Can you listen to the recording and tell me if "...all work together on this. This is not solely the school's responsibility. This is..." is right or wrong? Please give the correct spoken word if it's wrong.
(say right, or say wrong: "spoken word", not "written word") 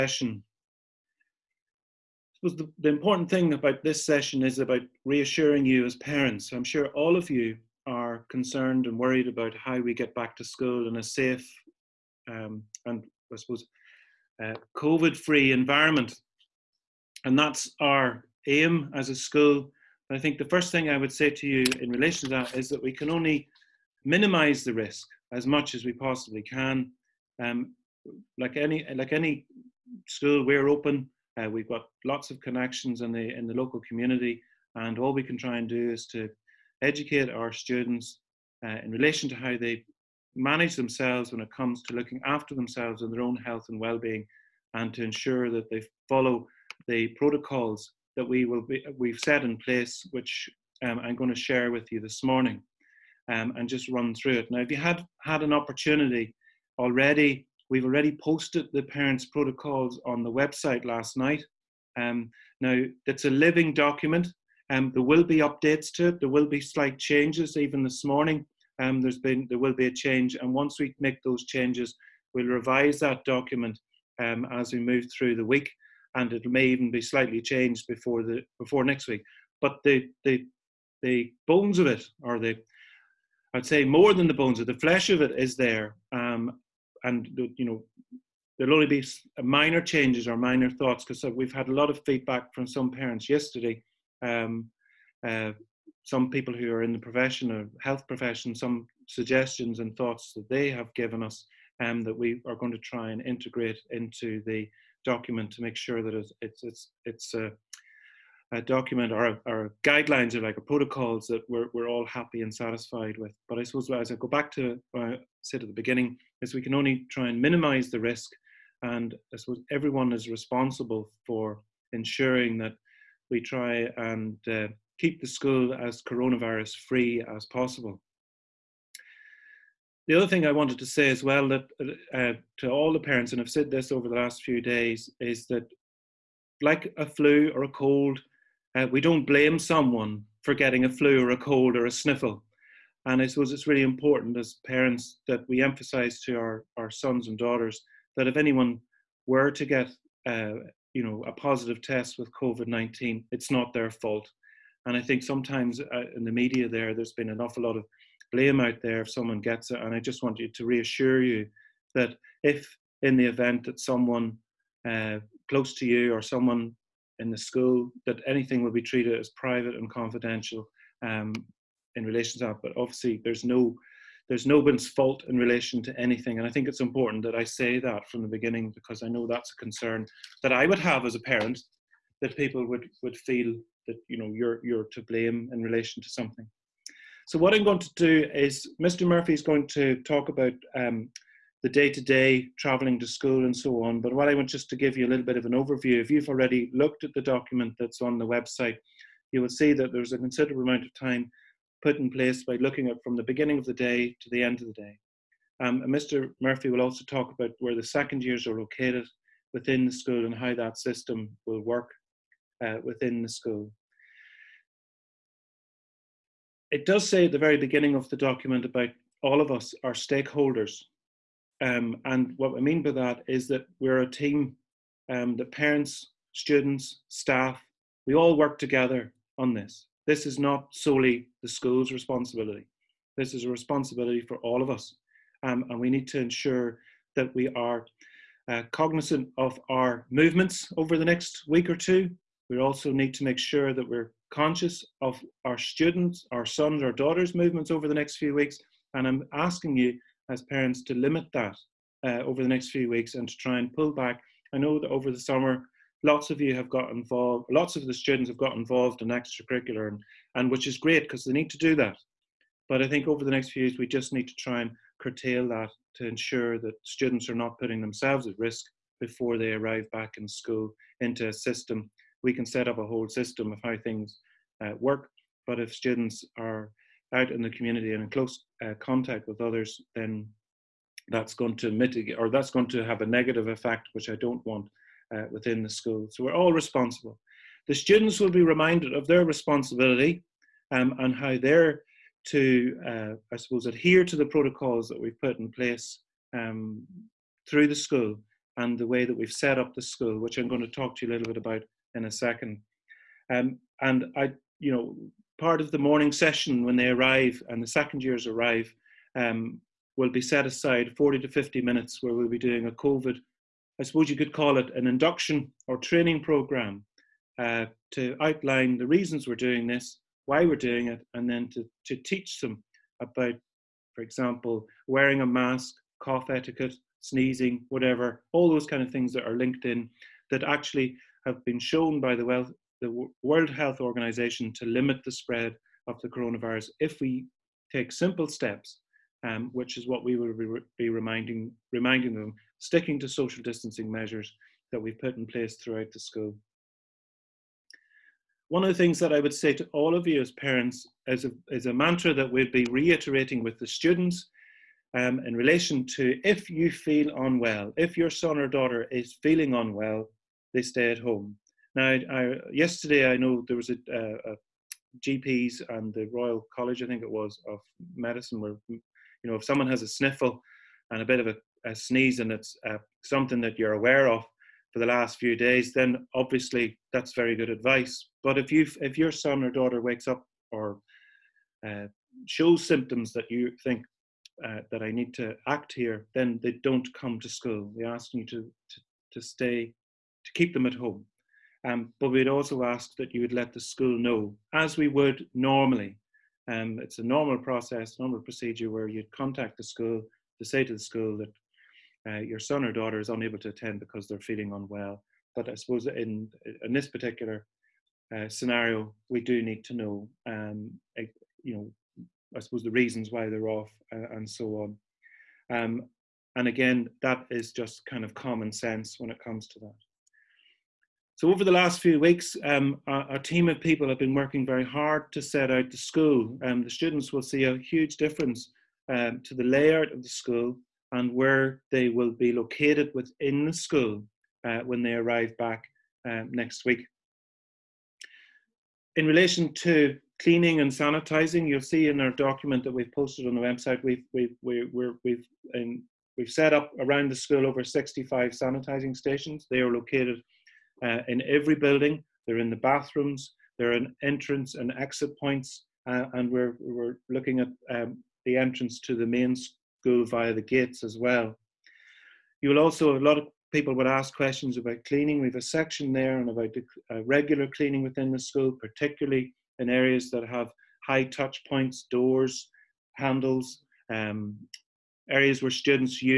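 right.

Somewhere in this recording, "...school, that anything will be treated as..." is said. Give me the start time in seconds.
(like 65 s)
167 s.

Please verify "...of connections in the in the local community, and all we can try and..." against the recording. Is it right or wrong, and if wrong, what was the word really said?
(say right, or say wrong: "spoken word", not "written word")
right.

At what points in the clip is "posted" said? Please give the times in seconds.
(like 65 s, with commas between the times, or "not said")
58 s, 442 s.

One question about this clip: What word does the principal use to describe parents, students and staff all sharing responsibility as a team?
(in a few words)
stakeholders.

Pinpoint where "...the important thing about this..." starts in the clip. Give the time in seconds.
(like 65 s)
2 s.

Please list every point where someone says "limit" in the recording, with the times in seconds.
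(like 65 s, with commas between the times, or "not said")
250 s, 334 s.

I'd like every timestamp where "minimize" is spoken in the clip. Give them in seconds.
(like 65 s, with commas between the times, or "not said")
24 s, 117 s.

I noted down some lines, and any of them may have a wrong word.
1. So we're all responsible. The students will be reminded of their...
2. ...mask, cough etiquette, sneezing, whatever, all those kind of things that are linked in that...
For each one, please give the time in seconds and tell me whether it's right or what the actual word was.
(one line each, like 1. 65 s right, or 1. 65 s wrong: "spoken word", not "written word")
1. 286 s right
2. 325 s right.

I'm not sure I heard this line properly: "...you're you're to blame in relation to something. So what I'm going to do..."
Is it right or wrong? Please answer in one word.
right.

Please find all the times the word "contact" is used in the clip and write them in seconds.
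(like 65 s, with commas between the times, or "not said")
278 s, 399 s.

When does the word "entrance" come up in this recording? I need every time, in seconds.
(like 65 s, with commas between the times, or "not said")
454 s, 458 s.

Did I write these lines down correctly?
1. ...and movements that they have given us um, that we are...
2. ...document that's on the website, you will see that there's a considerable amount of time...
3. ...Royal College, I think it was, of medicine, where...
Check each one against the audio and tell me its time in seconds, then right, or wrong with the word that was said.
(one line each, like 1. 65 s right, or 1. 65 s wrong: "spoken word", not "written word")
1. 99 s wrong: "thoughts", not "movements"
2. 197 s right
3. 366 s right.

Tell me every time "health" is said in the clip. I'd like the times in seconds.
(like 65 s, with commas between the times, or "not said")
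43 s, 97 s, 333 s.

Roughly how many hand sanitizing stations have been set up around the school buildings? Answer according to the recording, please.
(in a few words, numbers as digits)
over 65.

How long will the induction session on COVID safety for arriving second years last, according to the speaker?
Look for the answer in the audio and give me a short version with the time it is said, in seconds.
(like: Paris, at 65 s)
40 to 50 minutes, at 310 s.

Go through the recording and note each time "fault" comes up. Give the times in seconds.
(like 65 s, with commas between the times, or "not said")
153 s, 174 s.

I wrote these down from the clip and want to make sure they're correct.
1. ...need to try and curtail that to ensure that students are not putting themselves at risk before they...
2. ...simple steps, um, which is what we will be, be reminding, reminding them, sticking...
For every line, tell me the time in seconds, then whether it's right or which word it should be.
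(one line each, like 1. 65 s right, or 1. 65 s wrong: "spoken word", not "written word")
1. 264 s right
2. 337 s right.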